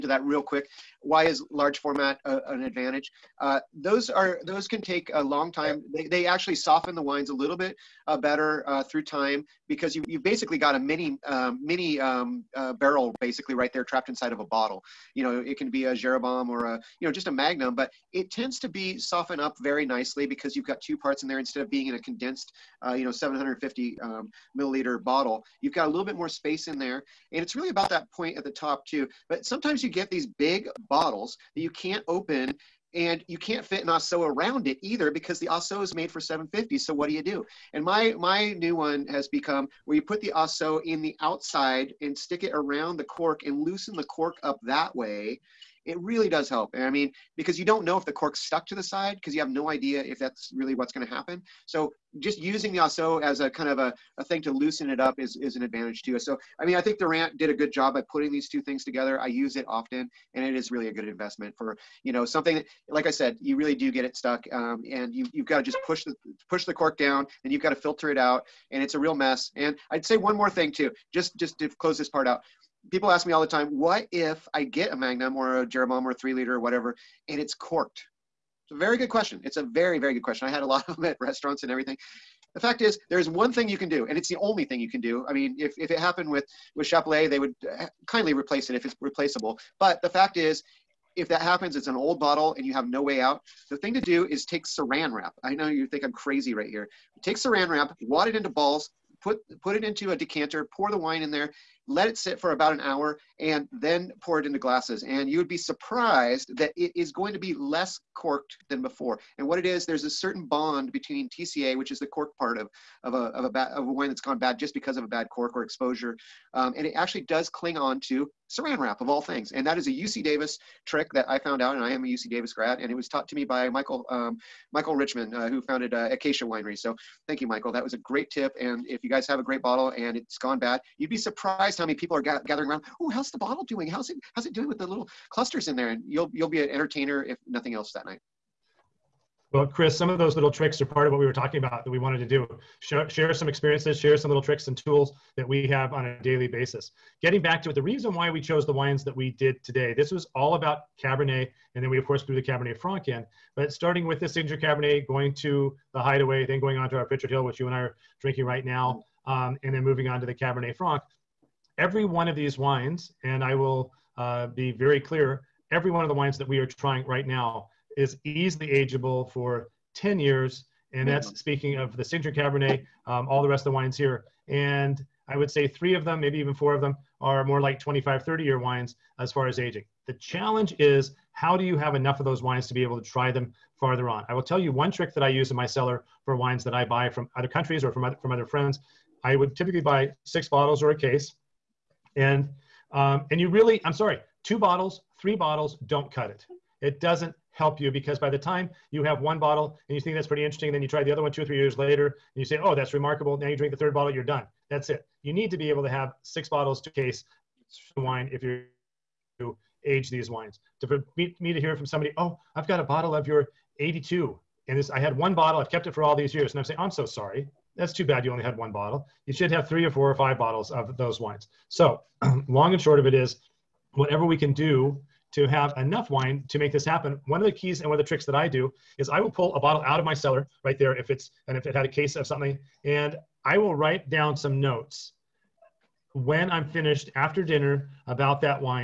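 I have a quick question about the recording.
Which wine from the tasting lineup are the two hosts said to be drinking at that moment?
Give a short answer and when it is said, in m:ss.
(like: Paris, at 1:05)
Pritchard Hill, at 2:37.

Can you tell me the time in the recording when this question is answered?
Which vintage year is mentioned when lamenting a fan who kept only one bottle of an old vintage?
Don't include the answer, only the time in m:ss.
3:33.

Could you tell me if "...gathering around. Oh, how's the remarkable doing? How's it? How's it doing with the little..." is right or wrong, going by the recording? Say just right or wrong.
wrong.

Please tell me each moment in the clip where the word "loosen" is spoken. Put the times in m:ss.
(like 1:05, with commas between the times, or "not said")
0:43, 0:54.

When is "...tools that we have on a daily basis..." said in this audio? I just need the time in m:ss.
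2:24.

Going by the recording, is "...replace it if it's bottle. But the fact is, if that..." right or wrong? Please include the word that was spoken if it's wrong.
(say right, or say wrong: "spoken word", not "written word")
wrong: "replaceable", not "bottle".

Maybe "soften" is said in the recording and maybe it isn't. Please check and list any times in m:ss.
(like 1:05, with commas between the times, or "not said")
0:06, 0:18.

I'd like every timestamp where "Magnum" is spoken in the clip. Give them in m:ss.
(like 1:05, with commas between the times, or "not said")
0:17, 1:14.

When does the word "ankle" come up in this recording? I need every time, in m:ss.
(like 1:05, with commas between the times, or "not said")
not said.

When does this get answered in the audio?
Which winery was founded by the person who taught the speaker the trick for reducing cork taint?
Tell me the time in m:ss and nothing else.
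2:06.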